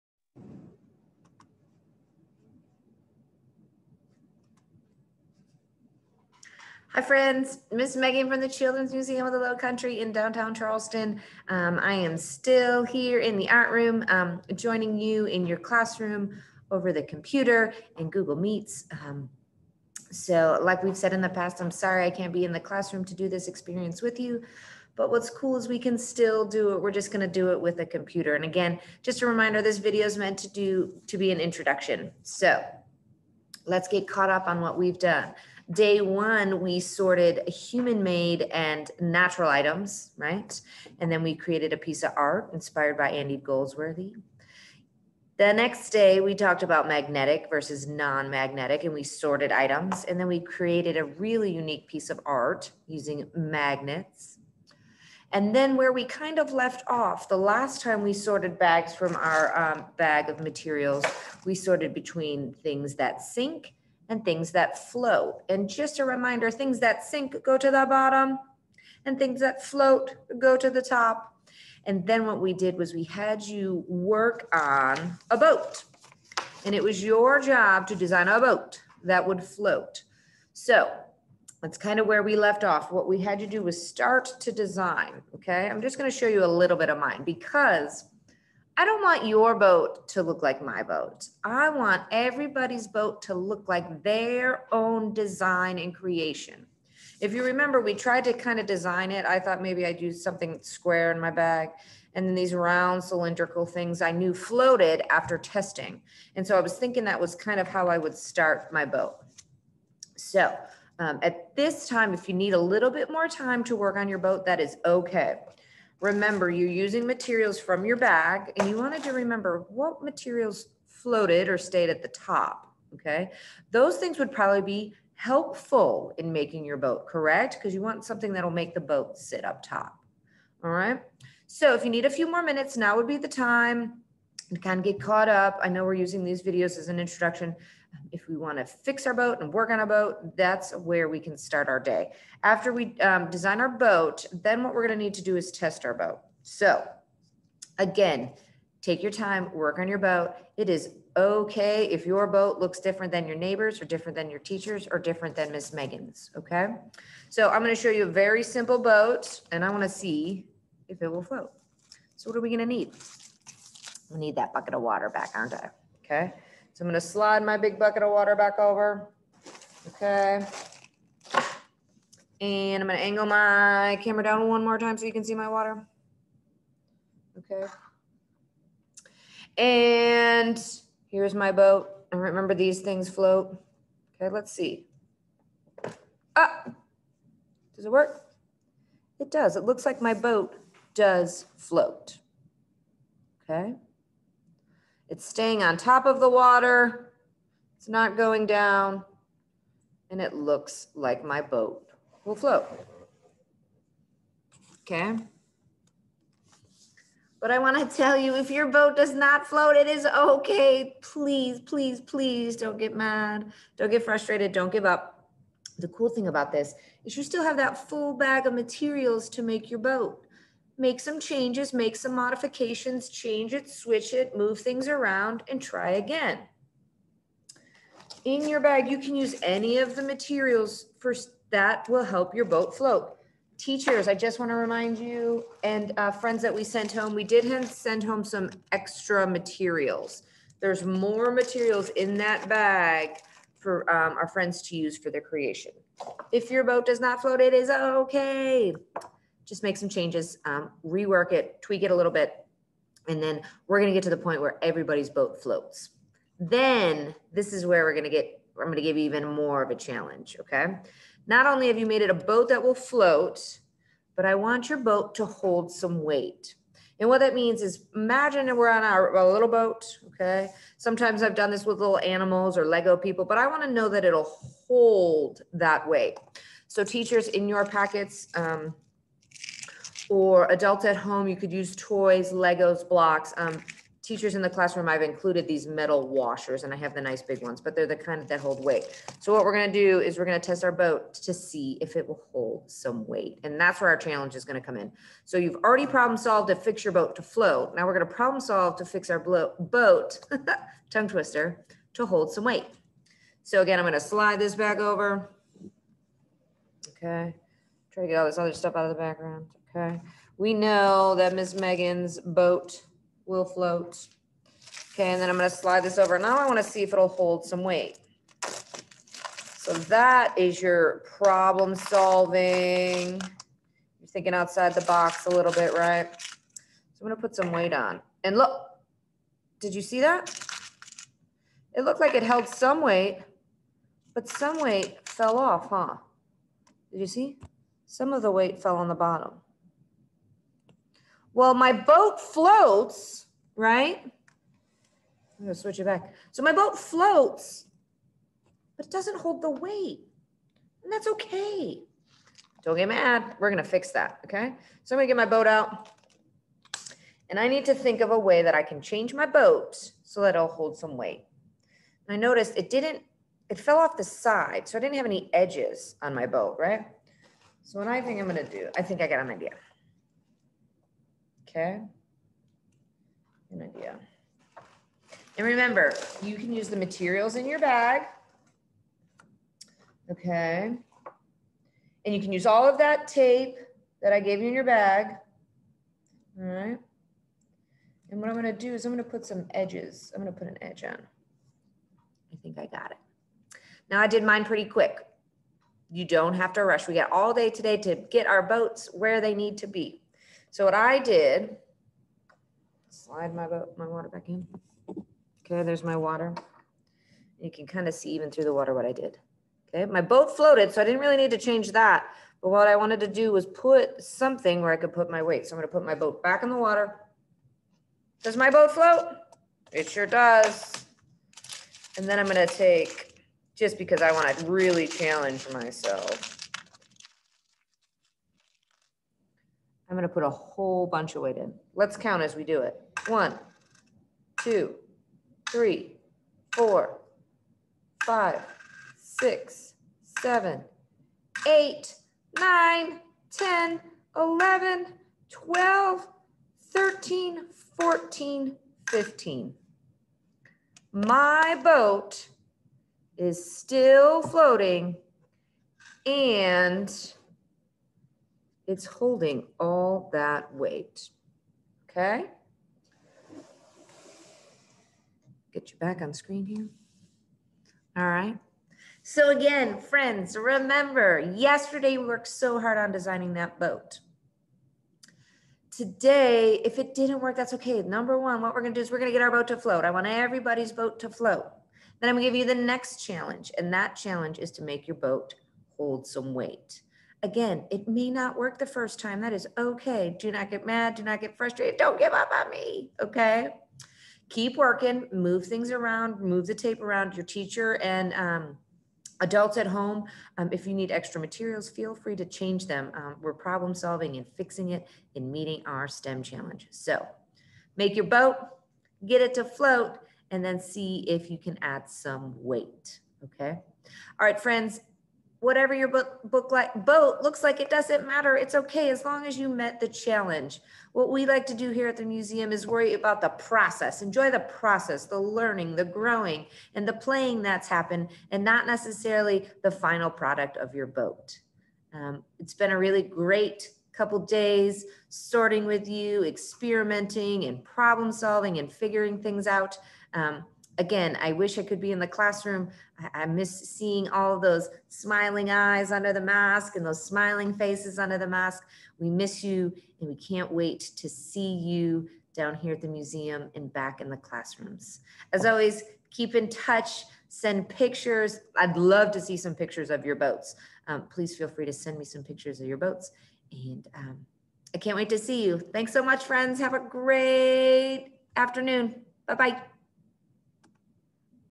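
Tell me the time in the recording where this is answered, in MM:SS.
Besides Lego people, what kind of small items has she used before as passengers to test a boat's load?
04:31.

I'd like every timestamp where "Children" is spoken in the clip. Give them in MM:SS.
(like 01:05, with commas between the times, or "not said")
00:08.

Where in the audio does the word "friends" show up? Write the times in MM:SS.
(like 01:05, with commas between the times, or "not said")
00:07, 03:56, 04:04, 07:49, 08:34, 09:26.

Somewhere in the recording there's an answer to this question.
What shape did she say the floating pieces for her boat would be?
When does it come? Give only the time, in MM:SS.
01:42.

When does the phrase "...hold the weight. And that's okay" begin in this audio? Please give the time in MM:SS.
05:49.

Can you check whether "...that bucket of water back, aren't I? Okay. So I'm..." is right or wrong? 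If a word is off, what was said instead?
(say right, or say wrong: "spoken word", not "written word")
right.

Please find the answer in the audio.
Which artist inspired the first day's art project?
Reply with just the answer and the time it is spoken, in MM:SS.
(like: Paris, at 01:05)
Andy Goldsworthy, at 00:43.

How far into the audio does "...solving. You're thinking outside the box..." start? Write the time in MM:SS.
05:21.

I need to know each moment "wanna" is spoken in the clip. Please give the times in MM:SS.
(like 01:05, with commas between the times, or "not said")
02:39, 04:33, 05:16, 07:04.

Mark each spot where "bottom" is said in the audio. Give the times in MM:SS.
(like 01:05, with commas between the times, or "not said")
01:07, 05:38.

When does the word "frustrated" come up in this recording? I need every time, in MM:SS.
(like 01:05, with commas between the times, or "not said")
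03:34, 08:11.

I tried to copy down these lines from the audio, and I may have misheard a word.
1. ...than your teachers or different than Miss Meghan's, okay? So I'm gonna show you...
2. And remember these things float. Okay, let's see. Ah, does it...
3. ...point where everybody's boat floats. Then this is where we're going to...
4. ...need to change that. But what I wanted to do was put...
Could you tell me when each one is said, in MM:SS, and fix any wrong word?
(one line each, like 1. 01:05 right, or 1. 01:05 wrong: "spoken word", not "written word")
1. 02:34 right
2. 03:02 right
3. 04:14 right
4. 06:51 right.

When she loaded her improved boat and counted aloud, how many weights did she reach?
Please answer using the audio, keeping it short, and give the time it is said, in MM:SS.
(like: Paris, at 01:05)
15, at 07:28.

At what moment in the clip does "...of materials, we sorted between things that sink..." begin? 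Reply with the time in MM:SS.
01:00.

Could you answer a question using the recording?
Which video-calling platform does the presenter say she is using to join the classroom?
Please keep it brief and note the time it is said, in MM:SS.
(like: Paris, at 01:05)
Google Meets, at 00:18.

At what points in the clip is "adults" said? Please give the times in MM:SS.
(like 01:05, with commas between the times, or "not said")
04:40, 08:19.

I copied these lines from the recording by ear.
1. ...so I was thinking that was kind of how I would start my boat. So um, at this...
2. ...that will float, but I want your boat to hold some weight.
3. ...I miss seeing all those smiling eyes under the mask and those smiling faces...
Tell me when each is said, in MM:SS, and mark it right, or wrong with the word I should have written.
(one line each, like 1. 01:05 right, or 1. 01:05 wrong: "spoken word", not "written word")
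1. 01:46 right
2. 04:22 right
3. 09:03 right.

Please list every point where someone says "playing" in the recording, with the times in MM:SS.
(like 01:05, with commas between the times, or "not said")
08:46.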